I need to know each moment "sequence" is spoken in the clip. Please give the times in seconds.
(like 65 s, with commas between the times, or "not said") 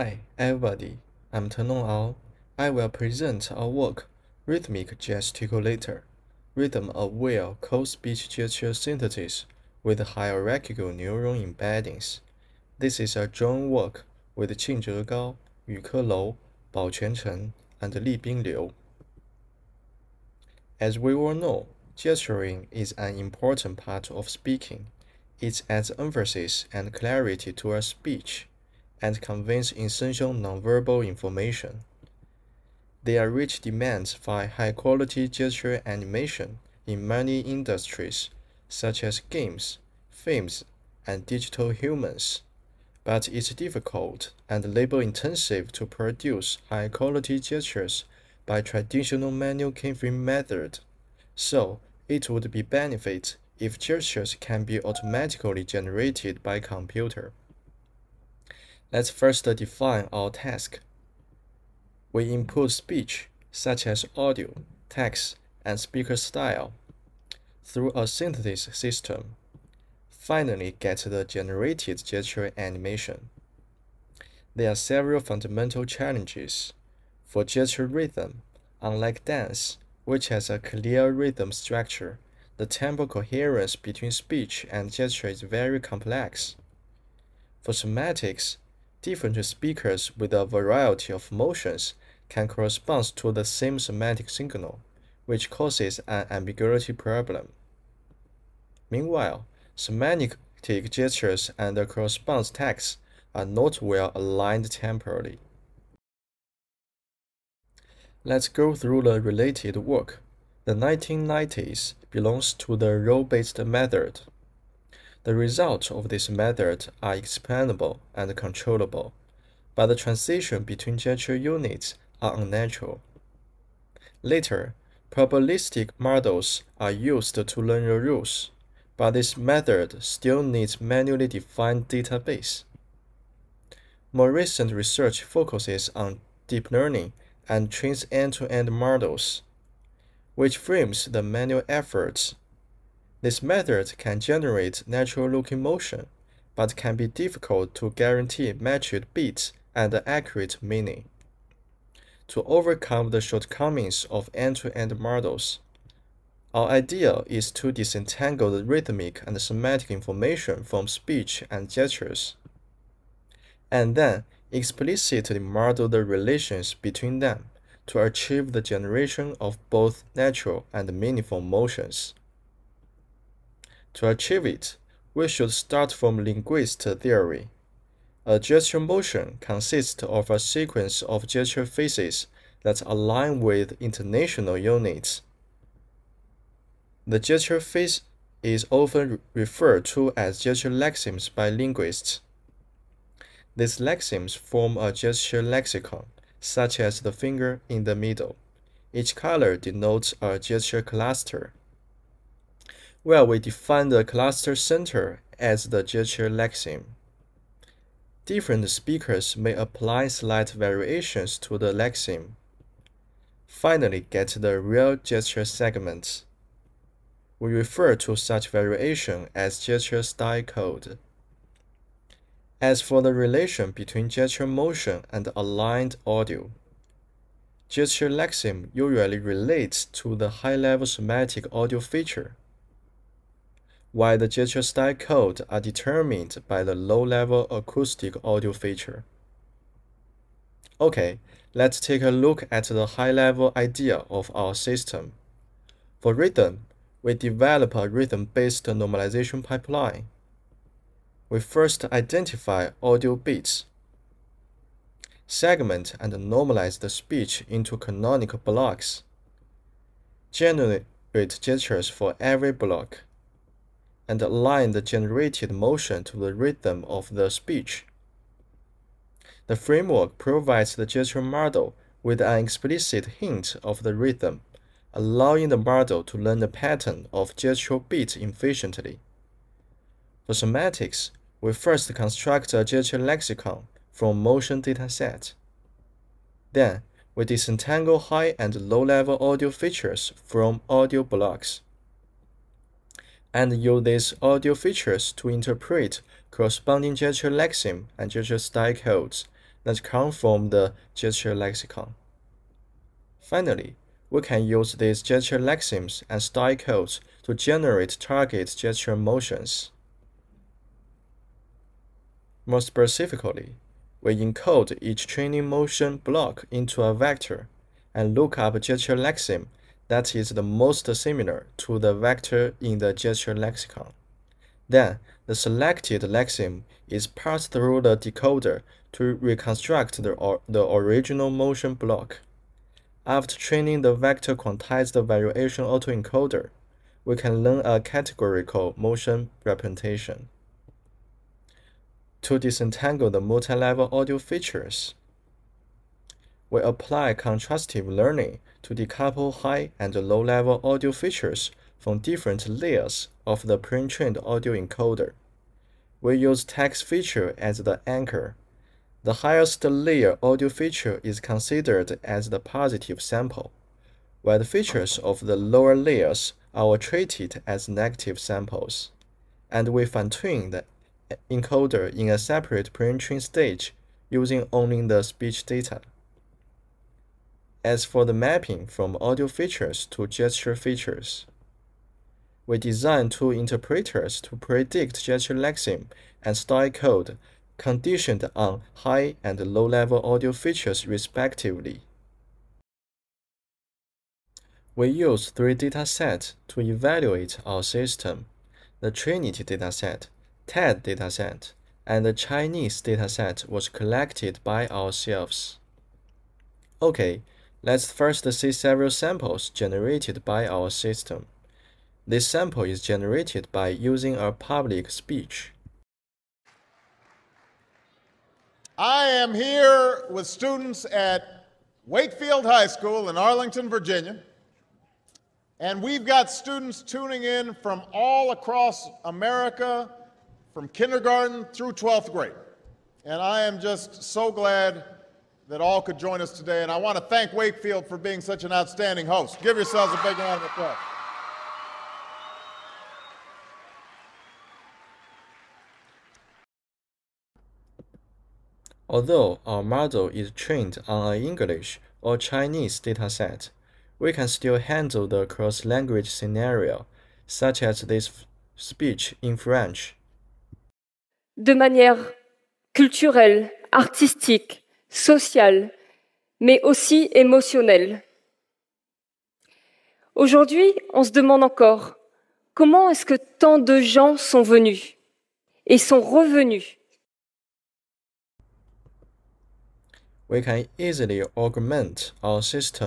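180 s.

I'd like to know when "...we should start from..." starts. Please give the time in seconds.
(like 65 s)
175 s.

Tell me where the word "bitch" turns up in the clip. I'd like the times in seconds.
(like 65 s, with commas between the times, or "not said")
not said.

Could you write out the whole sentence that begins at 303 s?
Finally, we can use these gesture lexemes and style codes to generate target gesture motions.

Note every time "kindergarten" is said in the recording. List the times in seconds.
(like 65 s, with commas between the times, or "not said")
430 s.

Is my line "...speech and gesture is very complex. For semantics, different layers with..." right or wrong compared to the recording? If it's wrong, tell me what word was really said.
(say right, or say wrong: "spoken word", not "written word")
wrong: "speakers", not "layers".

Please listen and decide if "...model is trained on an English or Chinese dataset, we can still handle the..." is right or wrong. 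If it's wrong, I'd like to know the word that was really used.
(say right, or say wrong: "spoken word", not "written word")
right.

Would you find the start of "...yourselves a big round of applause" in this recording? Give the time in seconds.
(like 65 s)
439 s.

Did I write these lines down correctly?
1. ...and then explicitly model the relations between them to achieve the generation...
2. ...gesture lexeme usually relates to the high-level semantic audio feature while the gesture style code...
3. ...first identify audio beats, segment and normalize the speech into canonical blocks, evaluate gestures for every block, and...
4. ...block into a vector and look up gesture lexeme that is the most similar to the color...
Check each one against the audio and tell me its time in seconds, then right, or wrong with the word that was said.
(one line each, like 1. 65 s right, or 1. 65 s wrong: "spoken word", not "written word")
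1. 163 s right
2. 227 s right
3. 251 s wrong: "generate", not "evaluate"
4. 315 s wrong: "vector", not "color".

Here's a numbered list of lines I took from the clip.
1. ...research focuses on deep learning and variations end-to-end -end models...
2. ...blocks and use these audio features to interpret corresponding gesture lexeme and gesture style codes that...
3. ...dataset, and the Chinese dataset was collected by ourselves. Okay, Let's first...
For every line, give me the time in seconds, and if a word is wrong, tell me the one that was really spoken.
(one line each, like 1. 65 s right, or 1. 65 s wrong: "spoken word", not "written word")
1. 134 s wrong: "trains", not "variations"
2. 291 s right
3. 400 s right.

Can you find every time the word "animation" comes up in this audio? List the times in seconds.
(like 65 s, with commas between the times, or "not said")
35 s, 72 s.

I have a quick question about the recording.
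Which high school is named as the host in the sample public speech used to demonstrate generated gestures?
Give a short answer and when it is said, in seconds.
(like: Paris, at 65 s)
Wakefield High School, at 421 s.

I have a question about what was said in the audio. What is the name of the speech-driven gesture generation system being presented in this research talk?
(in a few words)
Rhythmic Gesticulator.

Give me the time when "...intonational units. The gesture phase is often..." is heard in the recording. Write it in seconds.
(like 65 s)
183 s.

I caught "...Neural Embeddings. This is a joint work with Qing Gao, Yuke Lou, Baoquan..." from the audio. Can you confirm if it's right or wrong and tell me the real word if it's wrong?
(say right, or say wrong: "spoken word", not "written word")
right.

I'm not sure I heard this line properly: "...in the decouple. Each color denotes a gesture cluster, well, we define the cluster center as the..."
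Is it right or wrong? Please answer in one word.
wrong.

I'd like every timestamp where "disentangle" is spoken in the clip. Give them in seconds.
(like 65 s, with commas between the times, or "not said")
157 s, 287 s, 342 s.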